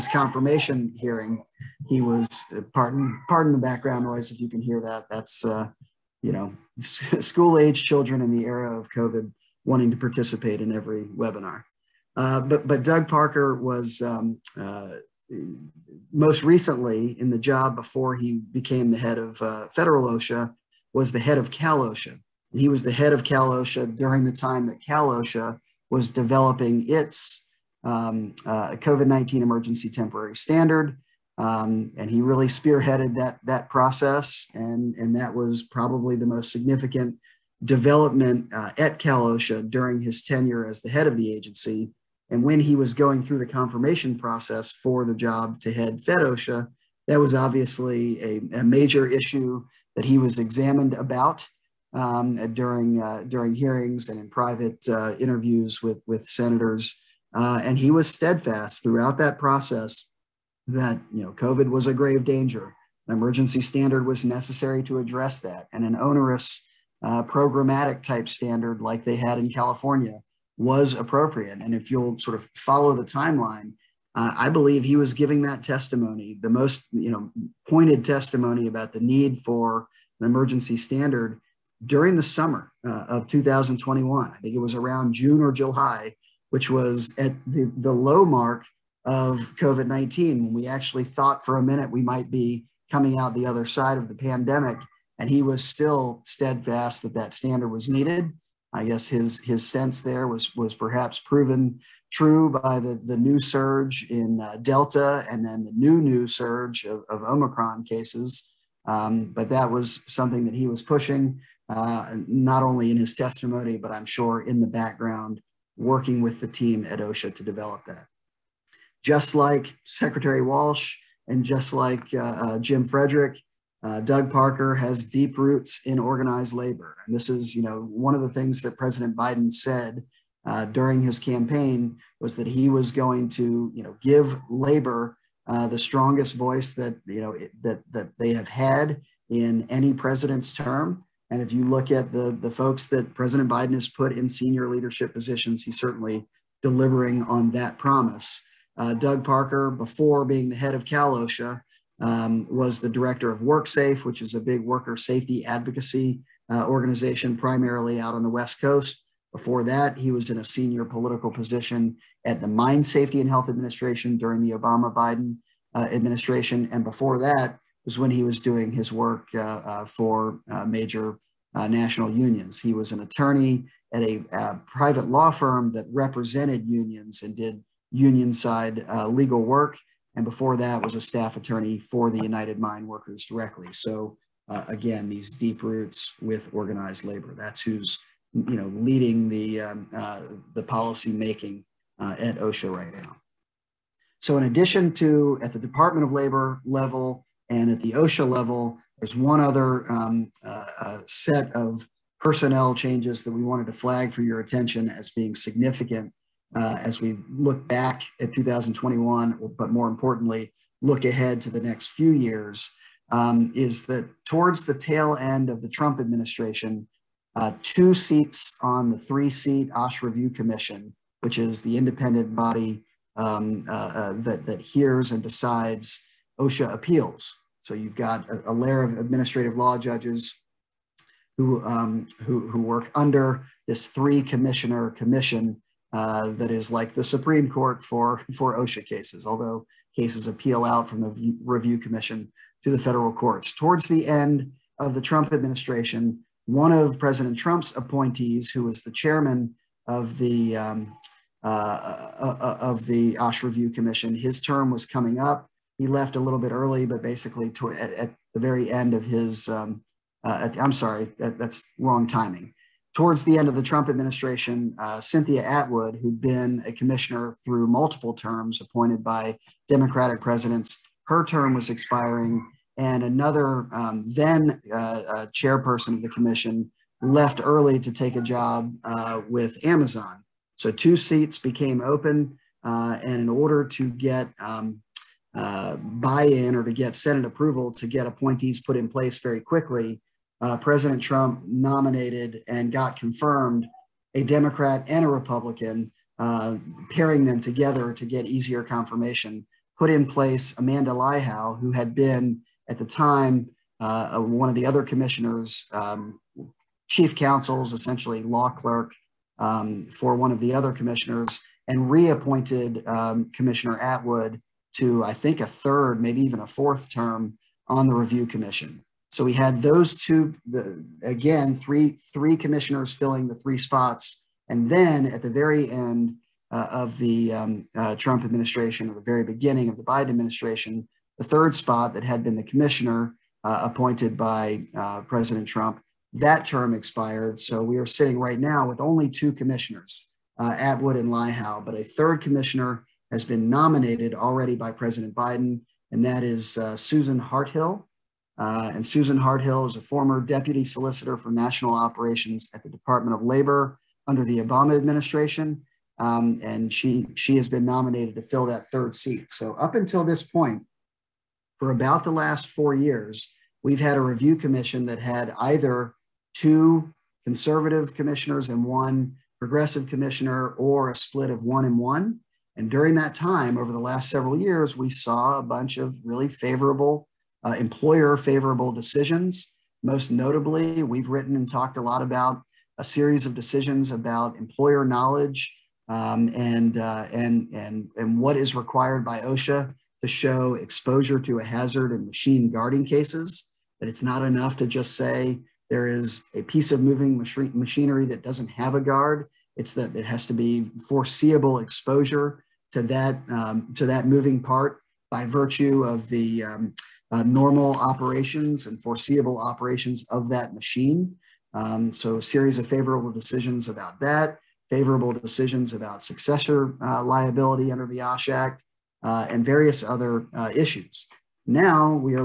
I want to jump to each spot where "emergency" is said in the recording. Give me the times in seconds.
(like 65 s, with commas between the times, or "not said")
29 s, 63 s, 80 s.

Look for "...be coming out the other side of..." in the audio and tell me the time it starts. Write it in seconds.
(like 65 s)
92 s.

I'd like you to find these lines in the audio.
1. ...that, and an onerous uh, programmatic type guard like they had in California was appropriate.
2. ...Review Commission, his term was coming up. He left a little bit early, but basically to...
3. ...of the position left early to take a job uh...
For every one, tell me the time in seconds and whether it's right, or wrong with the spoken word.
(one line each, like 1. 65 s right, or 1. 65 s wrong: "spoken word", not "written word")
1. 65 s wrong: "standard", not "guard"
2. 253 s right
3. 275 s wrong: "commission", not "position".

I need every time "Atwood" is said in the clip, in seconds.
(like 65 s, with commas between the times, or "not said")
265 s, 313 s, 340 s.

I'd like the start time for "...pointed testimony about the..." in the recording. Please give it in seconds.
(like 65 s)
77 s.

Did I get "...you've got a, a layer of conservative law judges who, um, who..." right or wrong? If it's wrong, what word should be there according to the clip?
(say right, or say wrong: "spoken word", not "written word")
wrong: "administrative", not "conservative".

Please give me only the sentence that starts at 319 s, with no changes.
So we had those two, the, again, three, three commissioners filling the three spots.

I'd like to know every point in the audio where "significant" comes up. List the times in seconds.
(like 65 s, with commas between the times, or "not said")
36 s, 205 s.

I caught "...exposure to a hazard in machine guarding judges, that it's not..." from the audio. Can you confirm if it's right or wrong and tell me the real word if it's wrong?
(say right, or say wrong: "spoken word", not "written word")
wrong: "cases", not "judges".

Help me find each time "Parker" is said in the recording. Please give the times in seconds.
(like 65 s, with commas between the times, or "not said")
13 s, 124 s, 149 s.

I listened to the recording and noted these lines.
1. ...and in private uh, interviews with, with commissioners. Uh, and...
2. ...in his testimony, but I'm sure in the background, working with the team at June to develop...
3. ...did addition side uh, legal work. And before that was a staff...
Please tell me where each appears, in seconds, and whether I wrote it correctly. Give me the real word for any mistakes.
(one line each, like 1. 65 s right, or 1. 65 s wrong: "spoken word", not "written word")
1. 54 s wrong: "senators", not "commissioners"
2. 112 s wrong: "OSHA", not "June"
3. 177 s wrong: "union", not "addition".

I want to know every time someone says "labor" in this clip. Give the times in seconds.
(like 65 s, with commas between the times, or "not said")
126 s, 134 s, 187 s, 196 s, 353 s.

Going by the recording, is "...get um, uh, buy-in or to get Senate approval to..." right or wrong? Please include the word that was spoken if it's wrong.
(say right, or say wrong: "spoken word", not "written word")
right.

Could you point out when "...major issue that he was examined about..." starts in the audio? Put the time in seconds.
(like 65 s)
48 s.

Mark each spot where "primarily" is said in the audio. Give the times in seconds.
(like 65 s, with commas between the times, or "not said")
157 s.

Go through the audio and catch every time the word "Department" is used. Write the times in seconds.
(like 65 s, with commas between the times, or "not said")
195 s, 352 s.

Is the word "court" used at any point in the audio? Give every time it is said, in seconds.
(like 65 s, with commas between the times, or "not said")
237 s, 243 s.